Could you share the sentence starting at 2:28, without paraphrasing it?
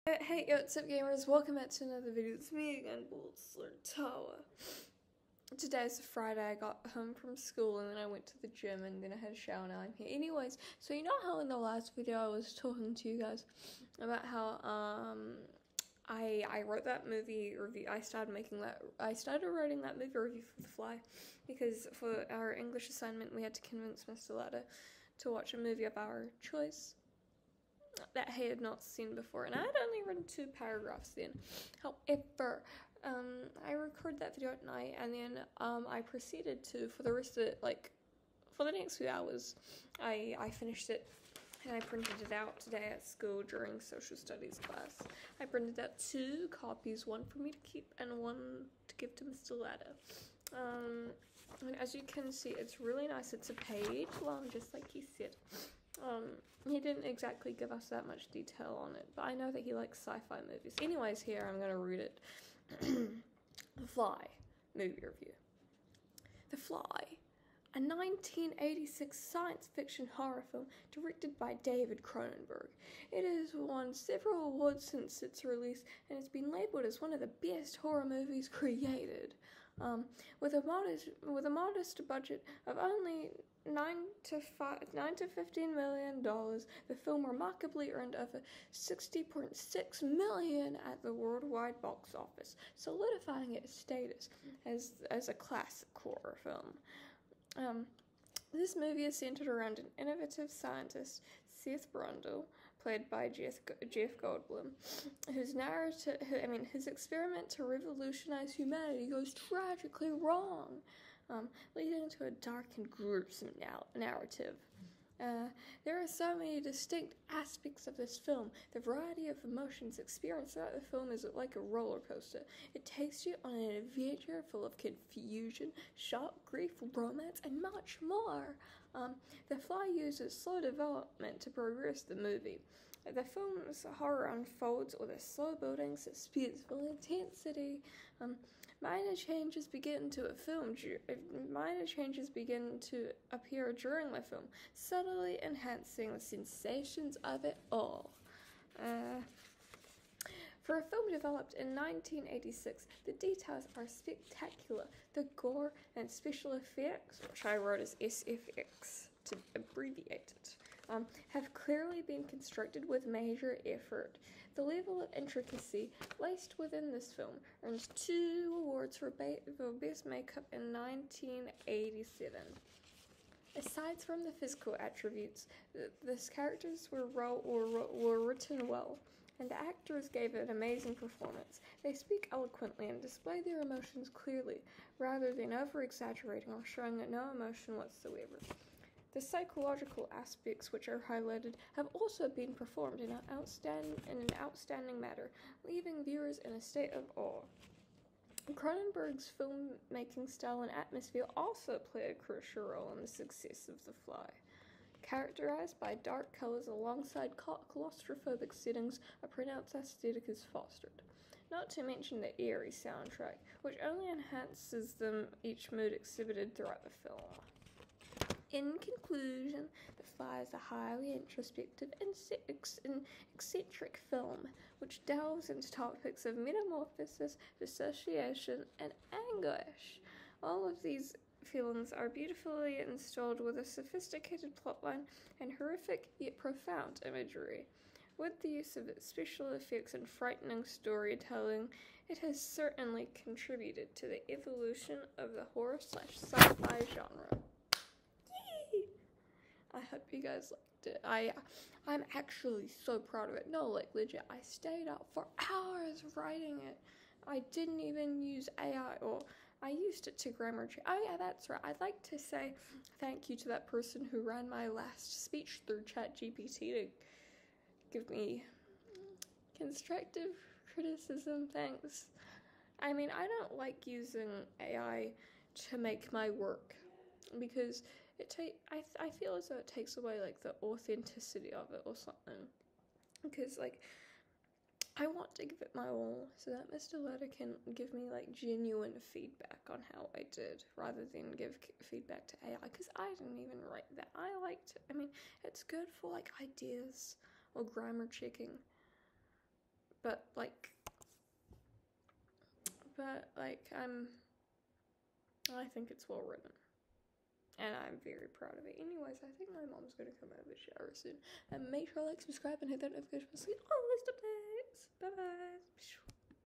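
Uh, for a film developed in 1986, the details are spectacular.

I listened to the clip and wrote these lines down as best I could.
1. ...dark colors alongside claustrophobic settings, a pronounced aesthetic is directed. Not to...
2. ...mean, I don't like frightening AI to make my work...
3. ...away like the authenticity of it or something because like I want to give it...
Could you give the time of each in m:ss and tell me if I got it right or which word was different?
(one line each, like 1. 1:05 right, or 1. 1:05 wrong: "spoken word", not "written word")
1. 3:26 wrong: "fostered", not "directed"
2. 4:32 wrong: "using", not "frightening"
3. 4:39 right.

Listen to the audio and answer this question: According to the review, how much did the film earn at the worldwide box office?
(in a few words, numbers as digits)
Over 60.6 million.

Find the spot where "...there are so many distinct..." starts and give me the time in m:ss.
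1:55.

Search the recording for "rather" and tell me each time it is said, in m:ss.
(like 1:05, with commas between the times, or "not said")
3:04, 4:50.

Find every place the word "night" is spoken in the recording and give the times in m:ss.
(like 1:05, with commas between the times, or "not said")
0:34.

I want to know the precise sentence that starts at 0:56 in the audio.
Um, he didn't exactly give us that much detail on it, but I know that he likes sci-fi movies.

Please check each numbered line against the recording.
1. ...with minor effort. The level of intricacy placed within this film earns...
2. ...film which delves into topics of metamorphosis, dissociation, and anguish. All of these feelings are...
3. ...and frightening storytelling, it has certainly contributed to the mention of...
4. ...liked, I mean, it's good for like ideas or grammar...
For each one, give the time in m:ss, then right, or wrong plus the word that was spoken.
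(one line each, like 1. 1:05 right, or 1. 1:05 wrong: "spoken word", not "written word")
1. 2:42 wrong: "major", not "minor"
2. 3:44 right
3. 3:59 wrong: "evolution", not "mention"
4. 4:54 right.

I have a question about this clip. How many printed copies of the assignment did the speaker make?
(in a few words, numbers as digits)
2.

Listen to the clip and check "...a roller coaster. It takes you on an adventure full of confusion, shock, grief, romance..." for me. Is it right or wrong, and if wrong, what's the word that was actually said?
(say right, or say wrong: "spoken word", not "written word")
right.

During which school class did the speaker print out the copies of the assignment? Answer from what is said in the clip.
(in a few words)
Social studies.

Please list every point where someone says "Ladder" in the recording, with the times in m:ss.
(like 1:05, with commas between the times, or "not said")
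0:24, 0:49.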